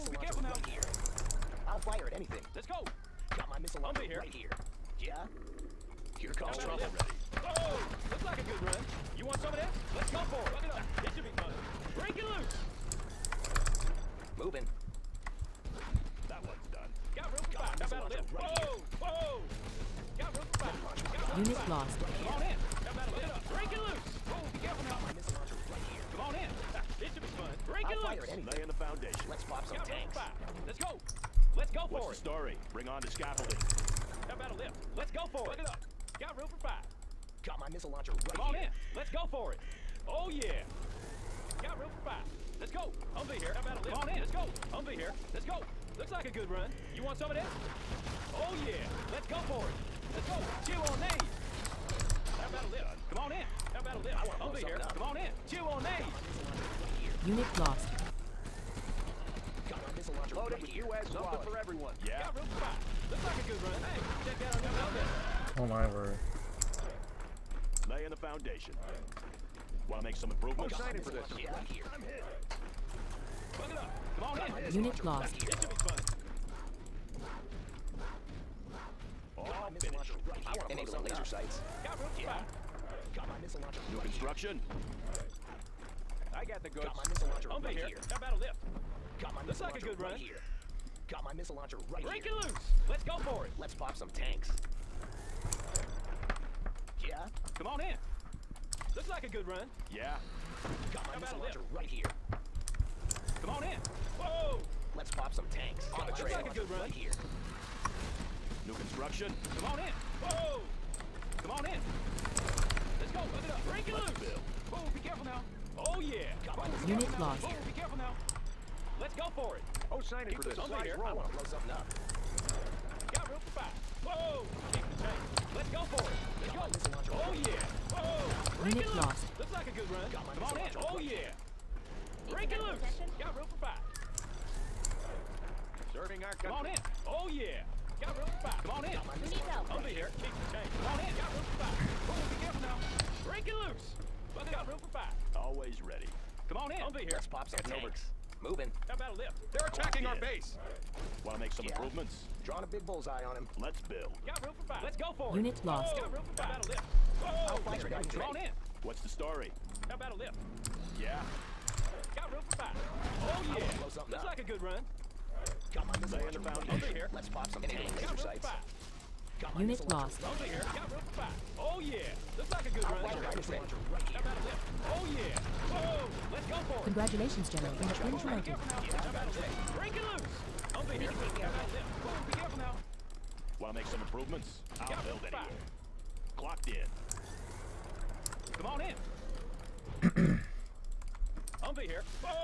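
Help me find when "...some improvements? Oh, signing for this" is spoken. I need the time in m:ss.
1:10.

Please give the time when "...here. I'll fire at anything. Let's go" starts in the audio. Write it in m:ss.
0:00.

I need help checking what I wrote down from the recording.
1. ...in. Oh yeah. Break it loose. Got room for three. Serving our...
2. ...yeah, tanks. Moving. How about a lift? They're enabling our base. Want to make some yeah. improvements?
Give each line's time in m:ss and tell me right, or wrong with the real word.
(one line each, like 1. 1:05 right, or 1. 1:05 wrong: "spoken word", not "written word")
1. 2:10 wrong: "five", not "three"
2. 2:27 wrong: "attacking", not "enabling".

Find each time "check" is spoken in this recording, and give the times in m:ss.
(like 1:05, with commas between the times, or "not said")
1:04.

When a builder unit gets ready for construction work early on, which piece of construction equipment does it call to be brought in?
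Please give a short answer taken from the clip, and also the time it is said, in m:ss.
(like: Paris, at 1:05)
scaffolding, at 0:33.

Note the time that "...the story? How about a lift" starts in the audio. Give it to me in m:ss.
2:38.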